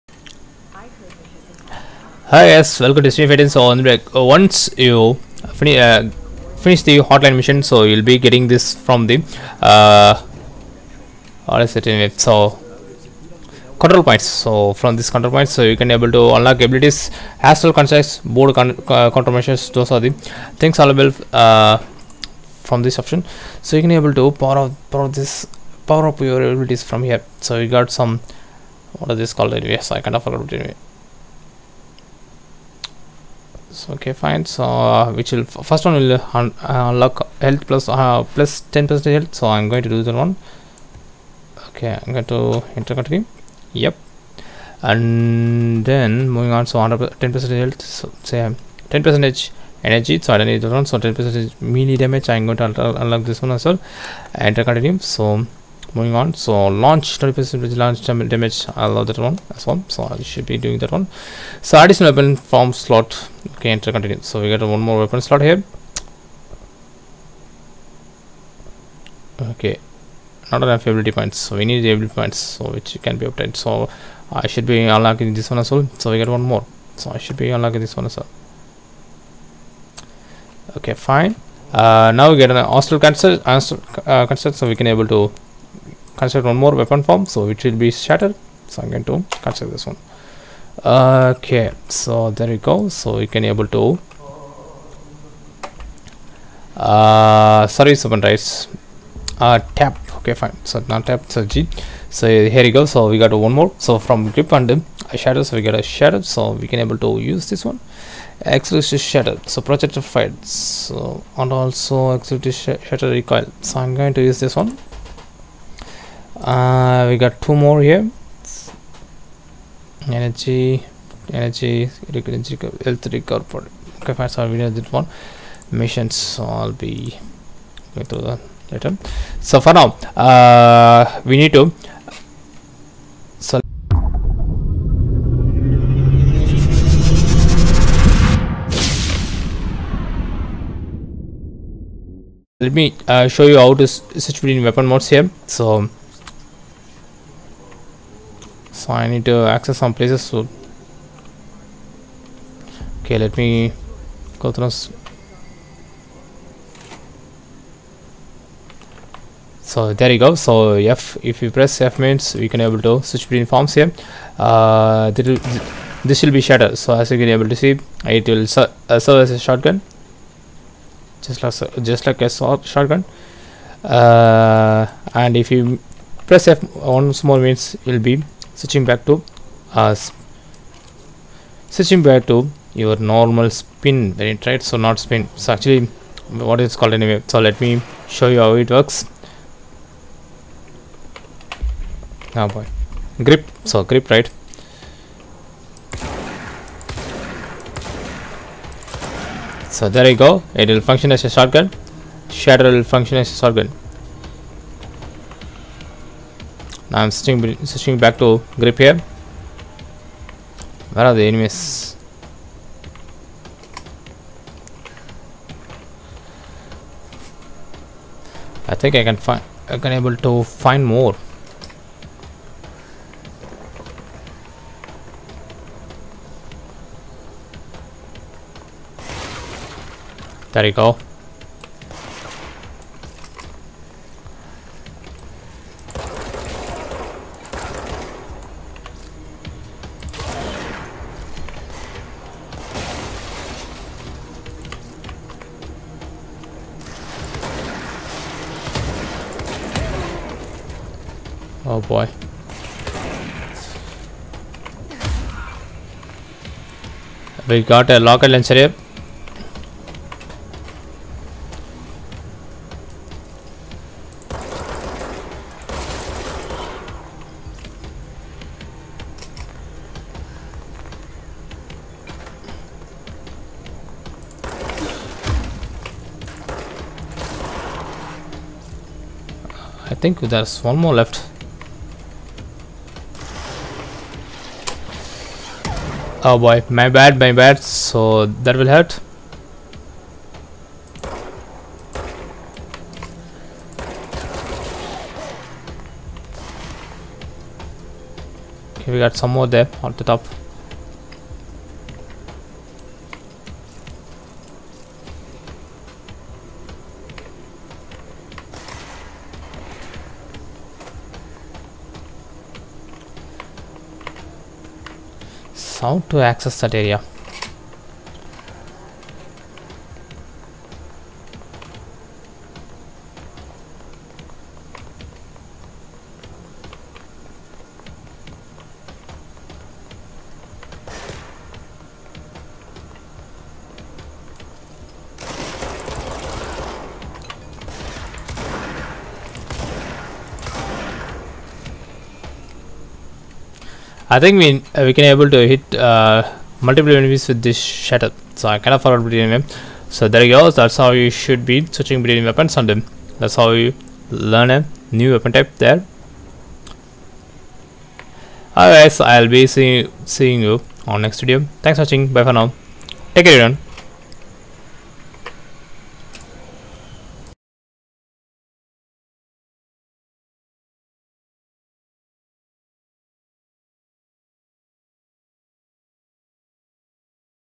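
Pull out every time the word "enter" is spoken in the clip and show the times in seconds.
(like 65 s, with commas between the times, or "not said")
42 s, 54 s, 63 s.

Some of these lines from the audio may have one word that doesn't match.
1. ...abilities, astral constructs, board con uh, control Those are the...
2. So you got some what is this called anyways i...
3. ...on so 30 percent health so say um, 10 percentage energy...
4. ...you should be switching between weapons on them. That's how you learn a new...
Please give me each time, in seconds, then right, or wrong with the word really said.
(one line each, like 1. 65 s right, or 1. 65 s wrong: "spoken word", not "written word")
1. 16 s right
2. 27 s right
3. 46 s wrong: "10", not "30"
4. 351 s right.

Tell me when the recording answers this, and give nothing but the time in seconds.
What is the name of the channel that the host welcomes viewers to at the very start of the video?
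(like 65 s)
3 s.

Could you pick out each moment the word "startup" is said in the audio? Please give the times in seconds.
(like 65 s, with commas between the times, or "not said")
not said.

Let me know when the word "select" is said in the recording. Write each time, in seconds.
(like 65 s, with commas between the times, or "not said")
133 s.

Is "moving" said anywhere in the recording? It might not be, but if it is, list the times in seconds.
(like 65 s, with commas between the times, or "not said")
46 s, 55 s.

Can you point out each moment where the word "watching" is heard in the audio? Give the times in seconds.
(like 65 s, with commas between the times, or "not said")
361 s.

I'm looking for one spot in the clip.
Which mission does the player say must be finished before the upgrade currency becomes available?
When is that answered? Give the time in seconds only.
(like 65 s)
7 s.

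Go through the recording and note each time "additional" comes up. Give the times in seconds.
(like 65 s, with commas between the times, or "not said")
61 s.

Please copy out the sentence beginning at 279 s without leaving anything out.
I think there's one more left.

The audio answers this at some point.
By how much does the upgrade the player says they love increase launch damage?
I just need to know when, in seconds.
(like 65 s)
57 s.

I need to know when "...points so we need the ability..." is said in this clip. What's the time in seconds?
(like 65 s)
71 s.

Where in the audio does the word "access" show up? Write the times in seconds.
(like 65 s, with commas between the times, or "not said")
149 s, 316 s.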